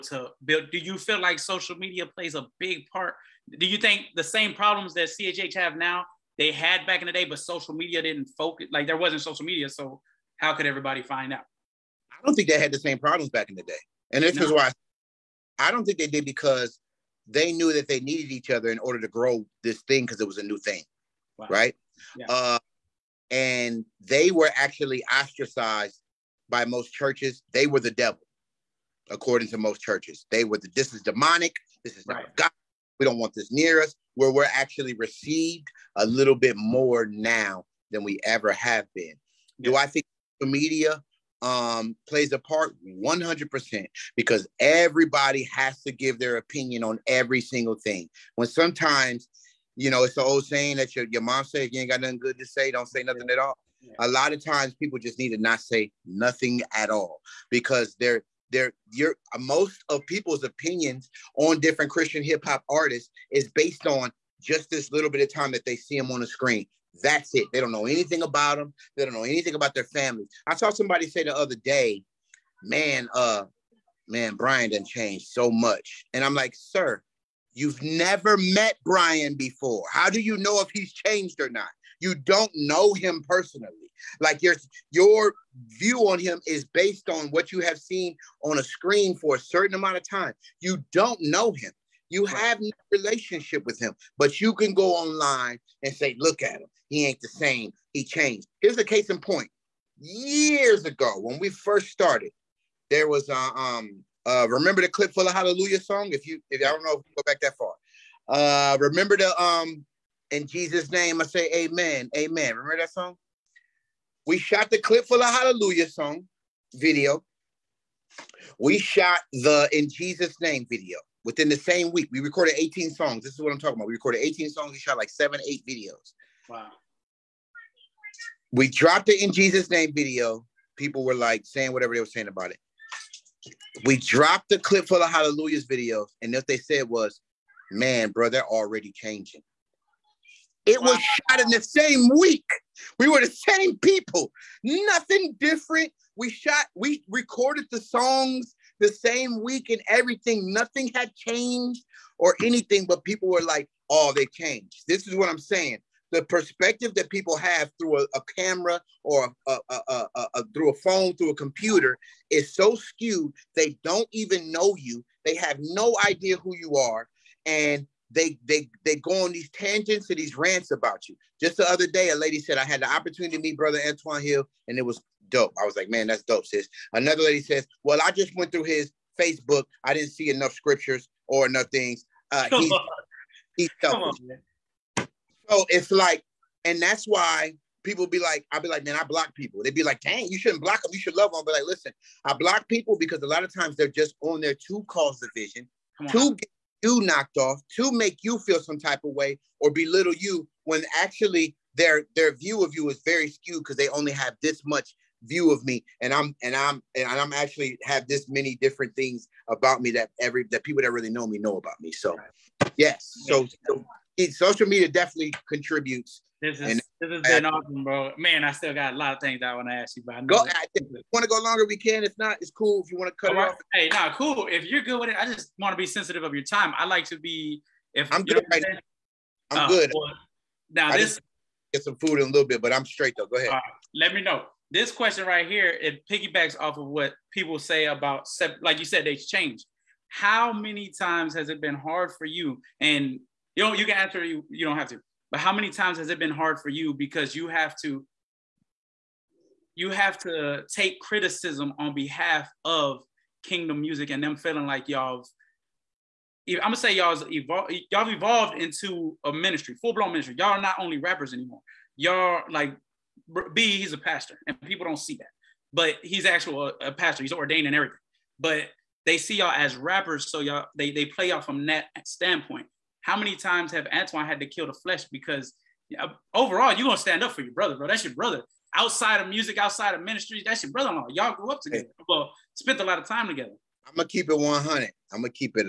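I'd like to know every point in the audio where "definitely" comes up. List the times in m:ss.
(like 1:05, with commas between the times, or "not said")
3:34.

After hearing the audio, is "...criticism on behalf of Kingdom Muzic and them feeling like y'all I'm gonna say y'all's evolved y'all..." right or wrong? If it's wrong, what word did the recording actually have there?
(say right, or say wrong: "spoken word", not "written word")
right.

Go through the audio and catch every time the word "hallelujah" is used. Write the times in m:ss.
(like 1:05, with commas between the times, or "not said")
1:45, 1:55, 2:15.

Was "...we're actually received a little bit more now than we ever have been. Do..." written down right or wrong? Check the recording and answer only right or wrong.
right.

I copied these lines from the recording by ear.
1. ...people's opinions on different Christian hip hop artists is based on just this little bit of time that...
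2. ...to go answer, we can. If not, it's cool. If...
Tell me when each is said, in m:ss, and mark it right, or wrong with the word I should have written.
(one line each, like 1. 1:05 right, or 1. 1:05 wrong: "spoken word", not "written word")
1. 1:00 right
2. 3:41 wrong: "longer", not "answer".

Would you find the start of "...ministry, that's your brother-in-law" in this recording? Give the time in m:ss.
4:40.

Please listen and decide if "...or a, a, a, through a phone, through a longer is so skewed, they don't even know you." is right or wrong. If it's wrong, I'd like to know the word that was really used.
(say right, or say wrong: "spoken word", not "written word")
wrong: "computer", not "longer".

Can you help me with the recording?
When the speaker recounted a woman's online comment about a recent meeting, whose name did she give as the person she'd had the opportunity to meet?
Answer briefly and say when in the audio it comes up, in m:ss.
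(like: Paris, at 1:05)
Antwoine Hill, at 2:53.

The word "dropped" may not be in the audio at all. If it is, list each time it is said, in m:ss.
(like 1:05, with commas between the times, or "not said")
2:08, 2:13.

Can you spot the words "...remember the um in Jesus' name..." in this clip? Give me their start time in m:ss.
1:48.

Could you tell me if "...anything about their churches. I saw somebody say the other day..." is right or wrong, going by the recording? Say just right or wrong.
wrong.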